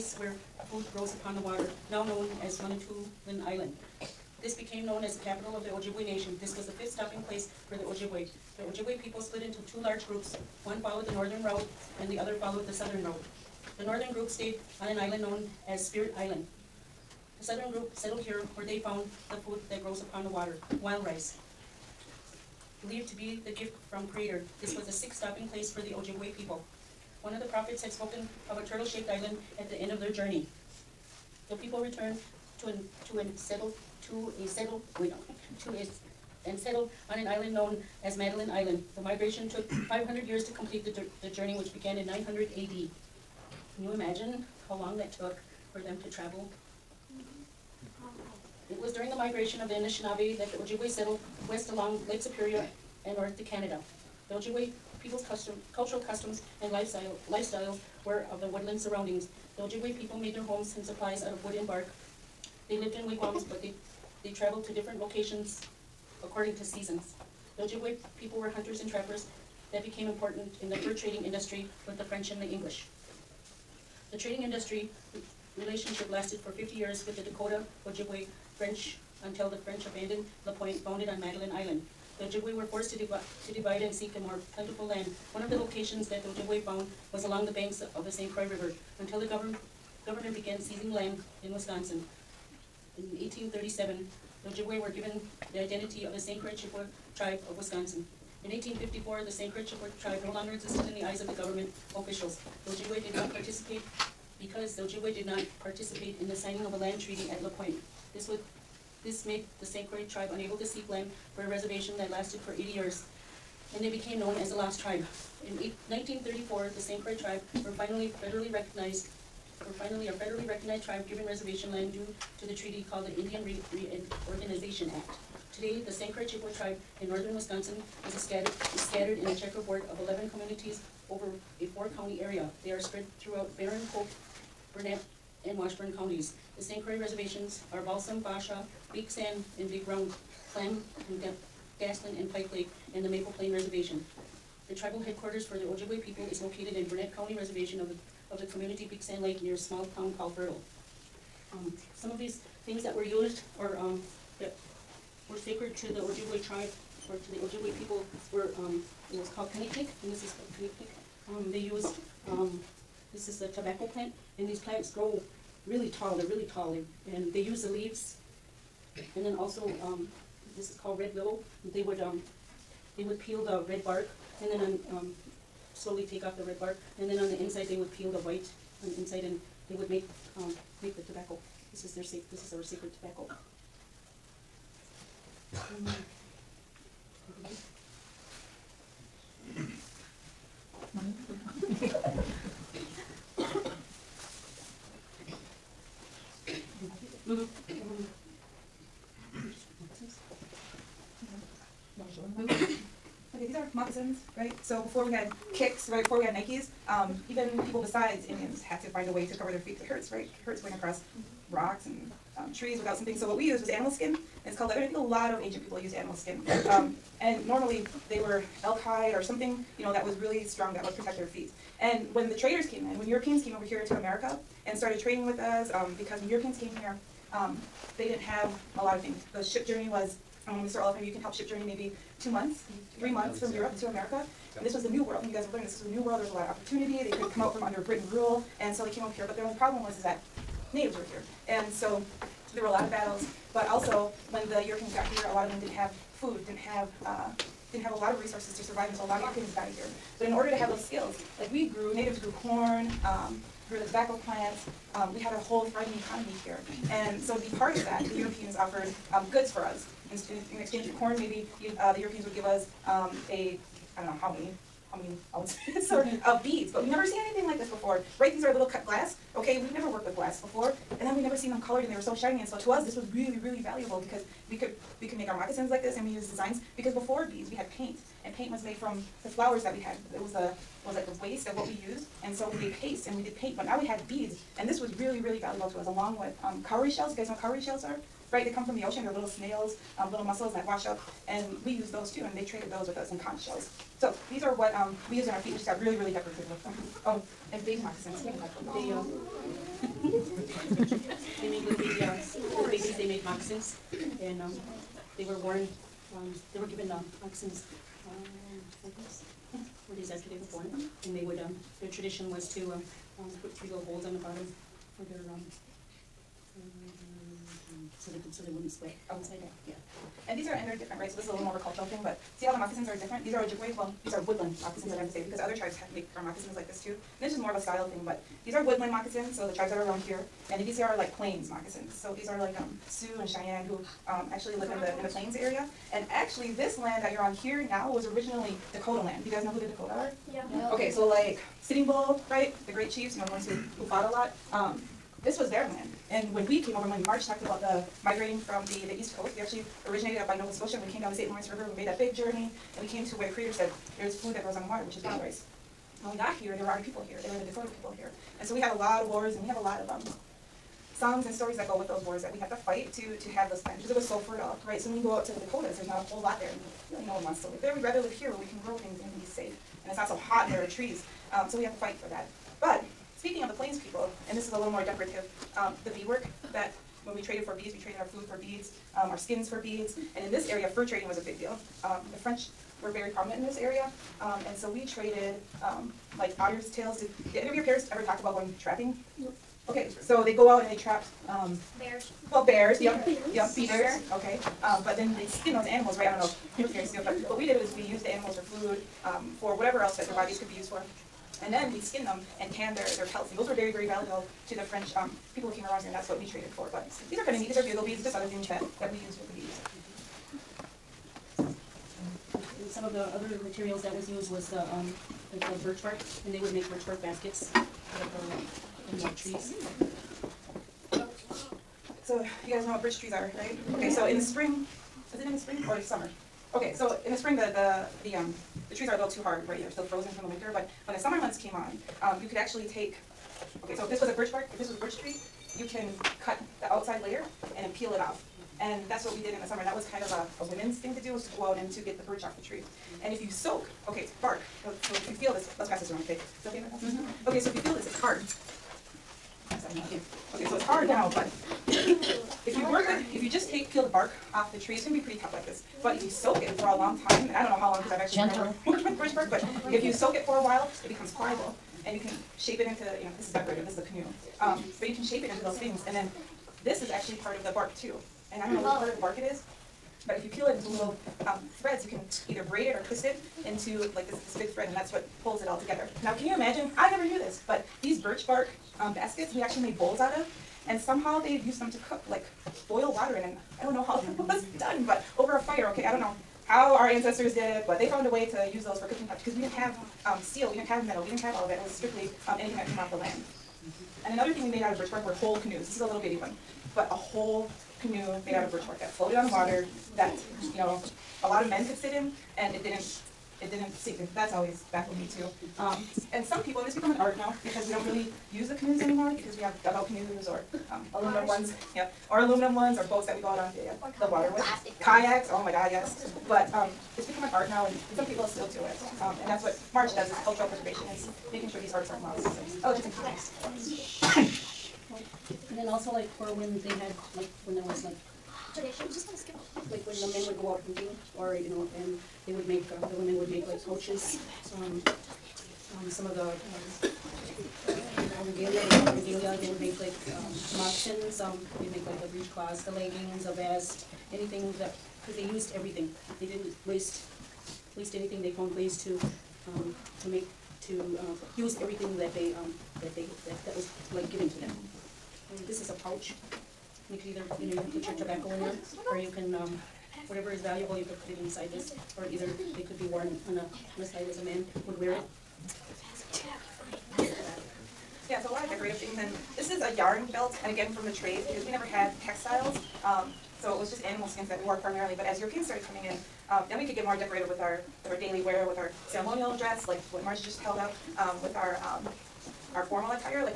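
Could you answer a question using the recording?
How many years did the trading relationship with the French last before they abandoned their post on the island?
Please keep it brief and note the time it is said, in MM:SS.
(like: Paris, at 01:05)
50 years, at 01:16.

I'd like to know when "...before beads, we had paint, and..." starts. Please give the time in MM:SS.
04:36.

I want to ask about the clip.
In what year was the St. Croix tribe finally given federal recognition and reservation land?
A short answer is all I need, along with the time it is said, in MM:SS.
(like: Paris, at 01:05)
1934, at 01:55.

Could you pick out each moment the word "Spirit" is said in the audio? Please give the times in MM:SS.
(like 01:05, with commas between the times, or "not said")
00:15.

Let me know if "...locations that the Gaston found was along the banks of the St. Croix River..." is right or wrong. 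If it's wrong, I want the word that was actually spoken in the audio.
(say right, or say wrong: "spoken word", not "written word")
wrong: "Ojibwe", not "Gaston".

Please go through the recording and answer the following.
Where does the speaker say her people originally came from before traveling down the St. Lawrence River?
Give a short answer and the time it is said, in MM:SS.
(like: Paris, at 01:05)
Nova Scotia, at 05:50.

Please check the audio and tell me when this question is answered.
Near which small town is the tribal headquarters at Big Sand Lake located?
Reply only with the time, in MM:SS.
02:30.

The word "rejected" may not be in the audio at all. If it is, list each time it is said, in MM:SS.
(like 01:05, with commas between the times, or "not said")
not said.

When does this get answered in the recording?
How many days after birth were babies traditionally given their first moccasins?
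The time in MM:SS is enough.
05:09.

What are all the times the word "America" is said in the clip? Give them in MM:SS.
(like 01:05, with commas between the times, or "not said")
03:43, 03:53.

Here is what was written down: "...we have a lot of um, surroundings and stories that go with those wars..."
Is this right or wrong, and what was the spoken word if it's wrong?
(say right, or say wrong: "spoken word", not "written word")
wrong: "songs", not "surroundings".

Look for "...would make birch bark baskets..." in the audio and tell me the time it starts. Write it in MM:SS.
06:56.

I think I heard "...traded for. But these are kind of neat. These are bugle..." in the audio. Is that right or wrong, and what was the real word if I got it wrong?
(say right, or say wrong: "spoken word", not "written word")
right.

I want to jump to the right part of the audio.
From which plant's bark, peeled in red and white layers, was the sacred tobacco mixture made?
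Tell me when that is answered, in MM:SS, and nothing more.
02:50.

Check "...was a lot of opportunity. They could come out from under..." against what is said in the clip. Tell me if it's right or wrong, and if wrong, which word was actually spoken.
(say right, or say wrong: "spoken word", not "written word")
right.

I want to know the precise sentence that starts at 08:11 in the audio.
It was strictly um, anything that came off the land.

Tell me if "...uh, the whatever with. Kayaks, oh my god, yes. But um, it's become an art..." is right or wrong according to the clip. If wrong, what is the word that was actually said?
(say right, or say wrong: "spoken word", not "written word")
wrong: "water", not "whatever".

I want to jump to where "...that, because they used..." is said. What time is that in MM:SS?
09:04.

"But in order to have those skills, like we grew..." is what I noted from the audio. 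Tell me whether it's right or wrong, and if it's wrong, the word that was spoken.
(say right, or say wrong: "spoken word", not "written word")
right.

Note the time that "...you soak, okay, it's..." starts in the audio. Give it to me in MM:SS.
07:23.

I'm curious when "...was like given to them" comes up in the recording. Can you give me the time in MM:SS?
09:13.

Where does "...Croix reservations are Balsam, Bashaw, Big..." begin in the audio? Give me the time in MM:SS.
02:16.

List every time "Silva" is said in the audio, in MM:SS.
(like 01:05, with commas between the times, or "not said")
not said.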